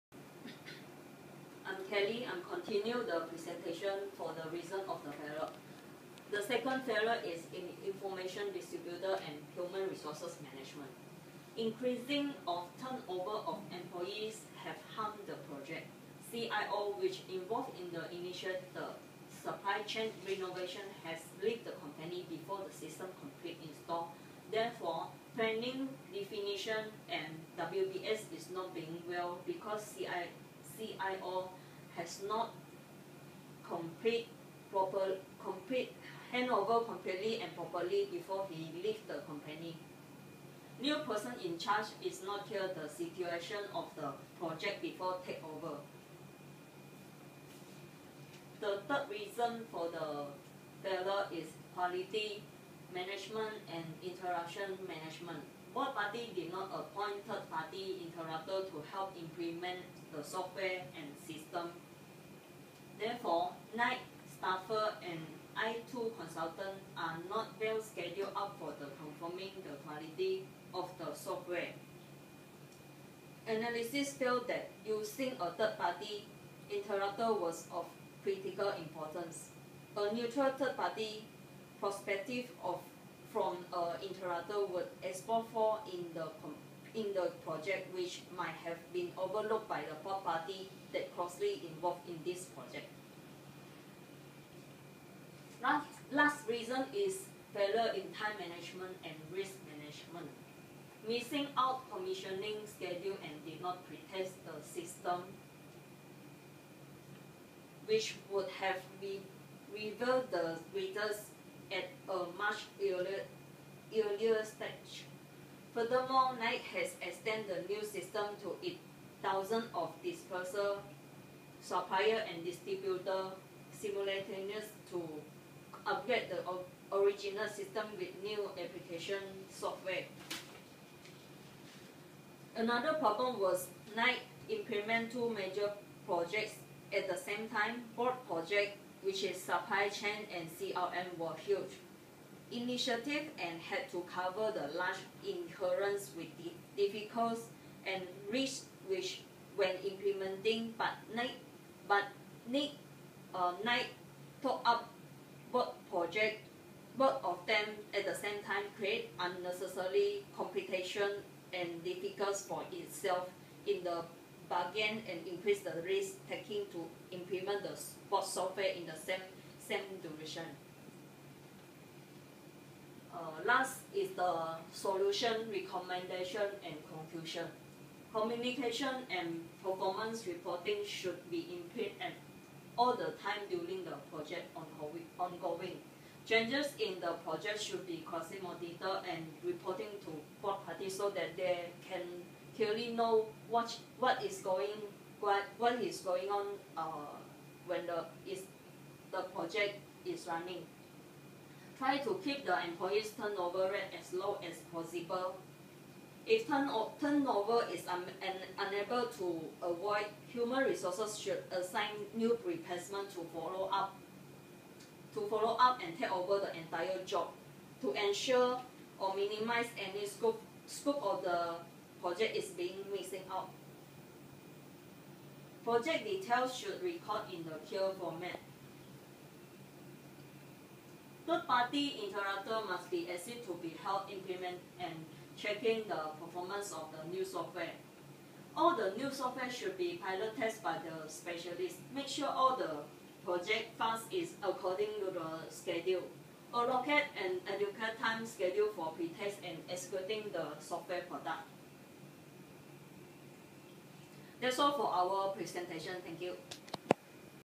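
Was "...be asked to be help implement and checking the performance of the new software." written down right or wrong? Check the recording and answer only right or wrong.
right.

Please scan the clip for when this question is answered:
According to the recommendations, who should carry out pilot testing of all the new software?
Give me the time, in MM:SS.
04:00.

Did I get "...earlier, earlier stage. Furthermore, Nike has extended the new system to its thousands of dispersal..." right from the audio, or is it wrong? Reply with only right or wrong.
right.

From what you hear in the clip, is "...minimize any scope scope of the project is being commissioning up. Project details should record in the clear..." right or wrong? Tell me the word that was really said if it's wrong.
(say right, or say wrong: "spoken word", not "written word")
wrong: "missing", not "commissioning".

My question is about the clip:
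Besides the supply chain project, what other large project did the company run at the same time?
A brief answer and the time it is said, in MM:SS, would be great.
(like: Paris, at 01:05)
CRM, at 02:20.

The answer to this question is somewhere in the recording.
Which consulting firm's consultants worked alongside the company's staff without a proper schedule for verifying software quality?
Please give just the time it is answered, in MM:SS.
01:05.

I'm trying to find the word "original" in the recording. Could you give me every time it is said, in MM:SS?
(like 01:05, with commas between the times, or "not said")
02:06.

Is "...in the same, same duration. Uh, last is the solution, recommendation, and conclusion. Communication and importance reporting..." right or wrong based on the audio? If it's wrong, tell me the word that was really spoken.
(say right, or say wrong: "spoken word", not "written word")
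wrong: "performance", not "importance".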